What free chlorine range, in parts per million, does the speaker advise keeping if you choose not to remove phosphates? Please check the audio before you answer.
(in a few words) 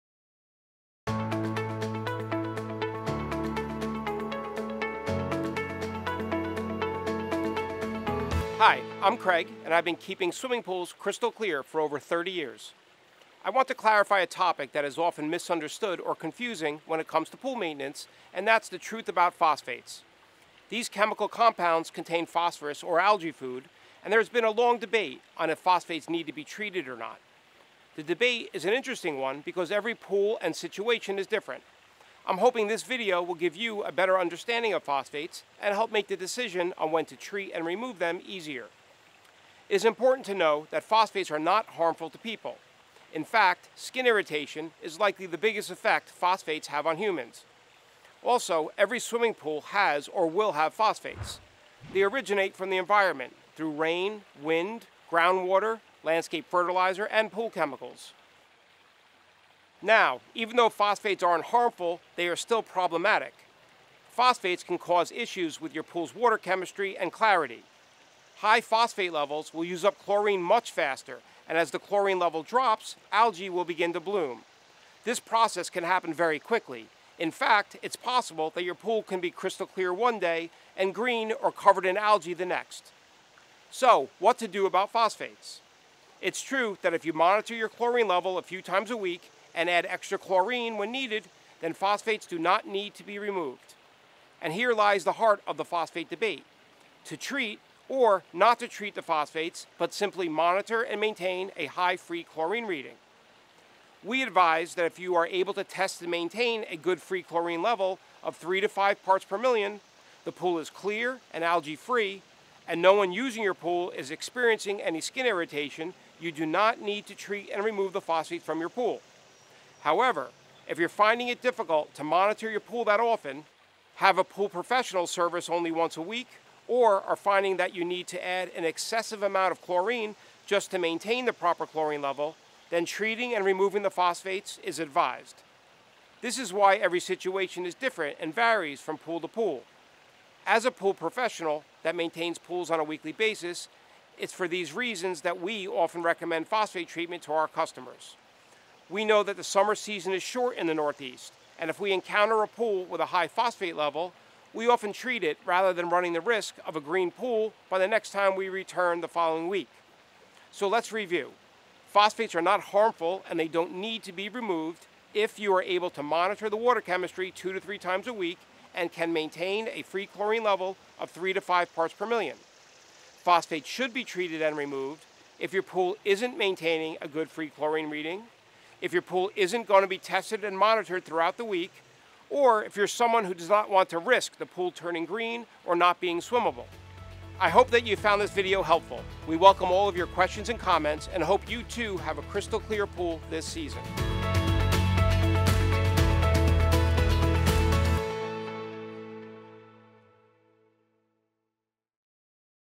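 3 to 5.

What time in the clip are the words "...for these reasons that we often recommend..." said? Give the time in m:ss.
2:24.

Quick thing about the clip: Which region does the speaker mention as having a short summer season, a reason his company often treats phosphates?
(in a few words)
Northeast.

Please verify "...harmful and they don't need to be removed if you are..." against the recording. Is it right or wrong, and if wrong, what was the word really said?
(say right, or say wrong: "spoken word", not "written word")
right.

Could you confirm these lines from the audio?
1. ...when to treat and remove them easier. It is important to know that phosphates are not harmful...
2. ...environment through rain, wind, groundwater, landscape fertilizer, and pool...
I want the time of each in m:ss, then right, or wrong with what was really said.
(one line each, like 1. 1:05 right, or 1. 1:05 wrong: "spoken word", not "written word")
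1. 0:36 right
2. 0:52 right.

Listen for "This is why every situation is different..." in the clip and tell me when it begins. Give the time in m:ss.
2:16.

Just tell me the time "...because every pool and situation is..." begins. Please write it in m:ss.
0:29.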